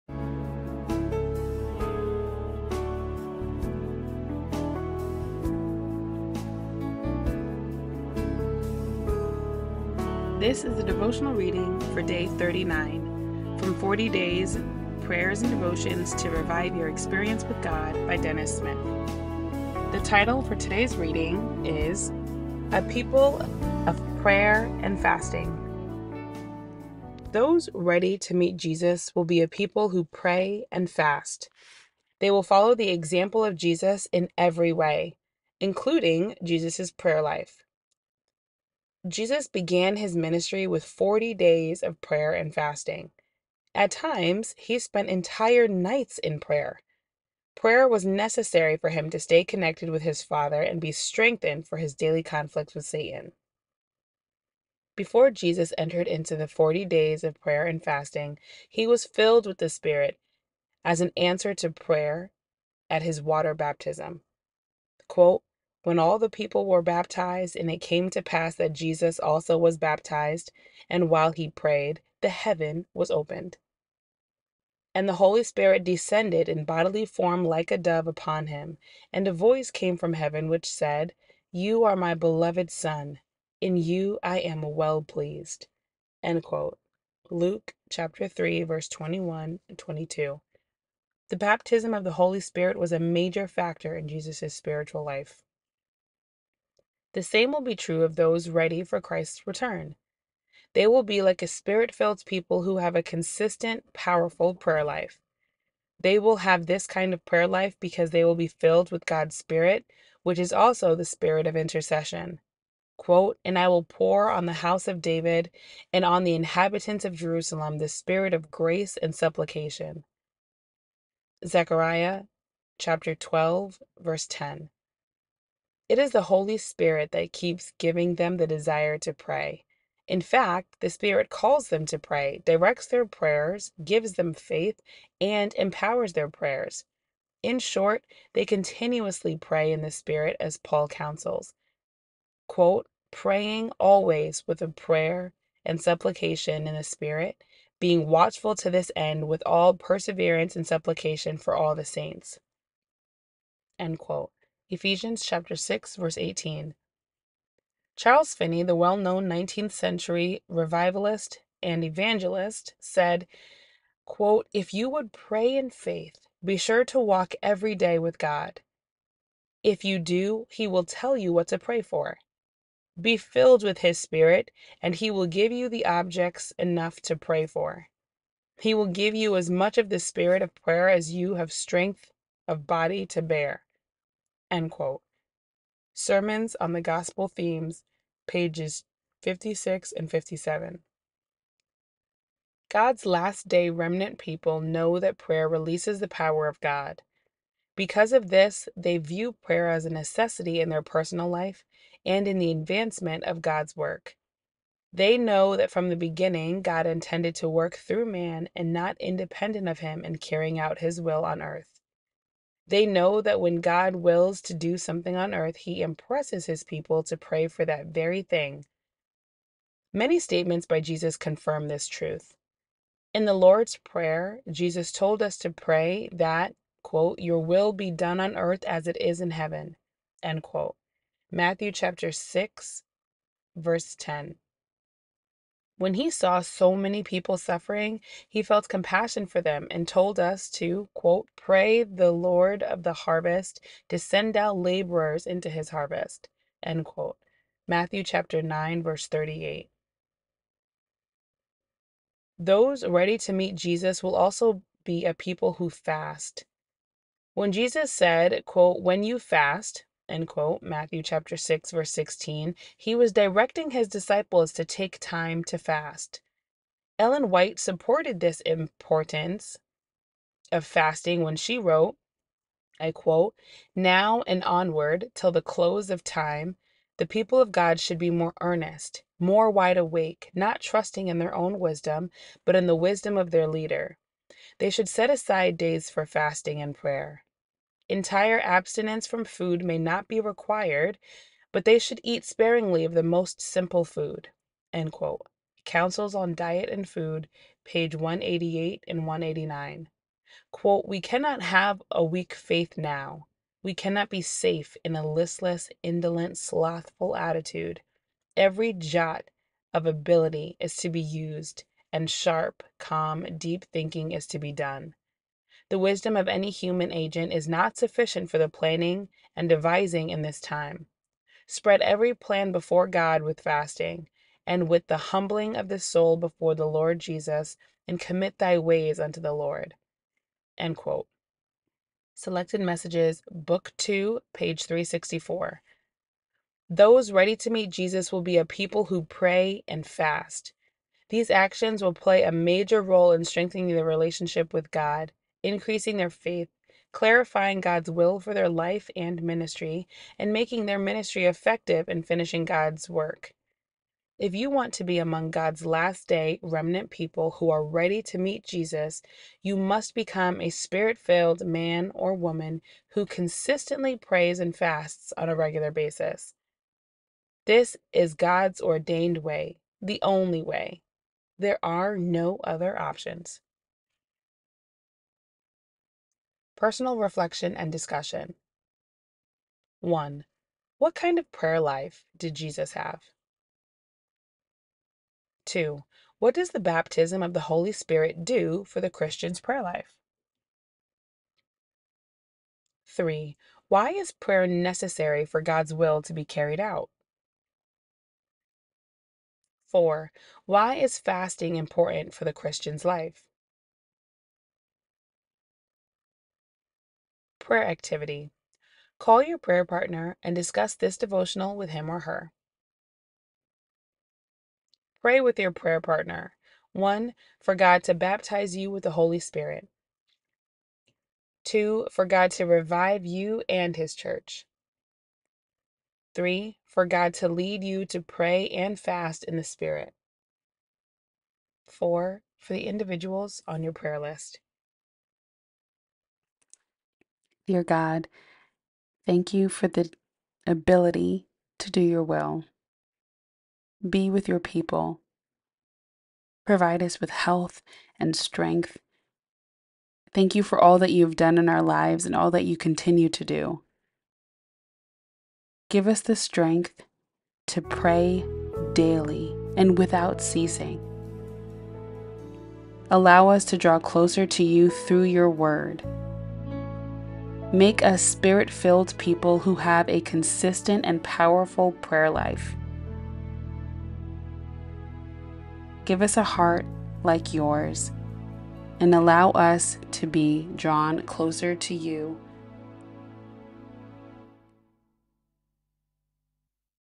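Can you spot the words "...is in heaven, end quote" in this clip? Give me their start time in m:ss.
3:48.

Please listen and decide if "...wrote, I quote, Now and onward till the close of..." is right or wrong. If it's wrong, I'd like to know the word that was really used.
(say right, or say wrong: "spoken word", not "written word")
right.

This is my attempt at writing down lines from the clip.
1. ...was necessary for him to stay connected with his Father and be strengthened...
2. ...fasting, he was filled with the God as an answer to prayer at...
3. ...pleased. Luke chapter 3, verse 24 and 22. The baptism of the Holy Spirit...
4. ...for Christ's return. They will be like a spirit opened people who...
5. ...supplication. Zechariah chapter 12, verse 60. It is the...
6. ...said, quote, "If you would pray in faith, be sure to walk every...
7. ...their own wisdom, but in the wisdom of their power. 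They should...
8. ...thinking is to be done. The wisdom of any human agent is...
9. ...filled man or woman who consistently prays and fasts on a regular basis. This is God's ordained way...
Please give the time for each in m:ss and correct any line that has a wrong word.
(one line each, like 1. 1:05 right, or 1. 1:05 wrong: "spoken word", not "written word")
1. 0:47 right
2. 0:57 wrong: "Spirit", not "God"
3. 1:25 wrong: "21", not "24"
4. 1:38 wrong: "filled", not "opened"
5. 1:59 wrong: "10", not "60"
6. 2:42 right
7. 4:41 wrong: "leader", not "power"
8. 5:13 right
9. 6:00 right.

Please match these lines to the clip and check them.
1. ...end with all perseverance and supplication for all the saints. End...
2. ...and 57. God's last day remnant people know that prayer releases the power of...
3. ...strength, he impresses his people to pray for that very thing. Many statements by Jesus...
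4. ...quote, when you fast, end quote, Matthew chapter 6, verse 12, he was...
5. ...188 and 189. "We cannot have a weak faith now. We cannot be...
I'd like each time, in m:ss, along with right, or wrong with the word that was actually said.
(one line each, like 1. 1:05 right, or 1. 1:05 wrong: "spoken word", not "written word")
1. 2:28 right
2. 3:09 right
3. 3:35 wrong: "earth", not "strength"
4. 4:18 wrong: "16", not "12"
5. 4:57 right.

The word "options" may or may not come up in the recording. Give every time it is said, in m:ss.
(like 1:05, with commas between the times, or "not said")
6:12.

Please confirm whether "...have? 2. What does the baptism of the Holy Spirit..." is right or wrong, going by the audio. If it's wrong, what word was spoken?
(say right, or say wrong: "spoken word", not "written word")
right.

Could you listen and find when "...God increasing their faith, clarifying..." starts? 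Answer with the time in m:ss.
5:44.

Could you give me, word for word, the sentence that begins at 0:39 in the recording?
Jesus began his ministry with 40 days of prayer and fasting.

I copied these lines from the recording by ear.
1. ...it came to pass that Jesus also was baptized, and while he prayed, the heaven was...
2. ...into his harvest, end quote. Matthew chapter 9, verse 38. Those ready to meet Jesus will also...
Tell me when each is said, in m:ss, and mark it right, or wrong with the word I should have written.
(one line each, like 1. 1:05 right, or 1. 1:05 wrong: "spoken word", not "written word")
1. 1:07 right
2. 4:05 right.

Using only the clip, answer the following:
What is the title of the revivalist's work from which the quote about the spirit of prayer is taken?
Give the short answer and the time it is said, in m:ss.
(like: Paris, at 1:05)
Sermons on the Gospel Themes, at 3:05.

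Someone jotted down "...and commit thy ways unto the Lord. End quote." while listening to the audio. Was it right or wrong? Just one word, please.
right.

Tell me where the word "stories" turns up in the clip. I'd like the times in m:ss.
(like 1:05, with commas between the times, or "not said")
not said.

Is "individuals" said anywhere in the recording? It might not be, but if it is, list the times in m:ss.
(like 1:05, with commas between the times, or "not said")
7:12.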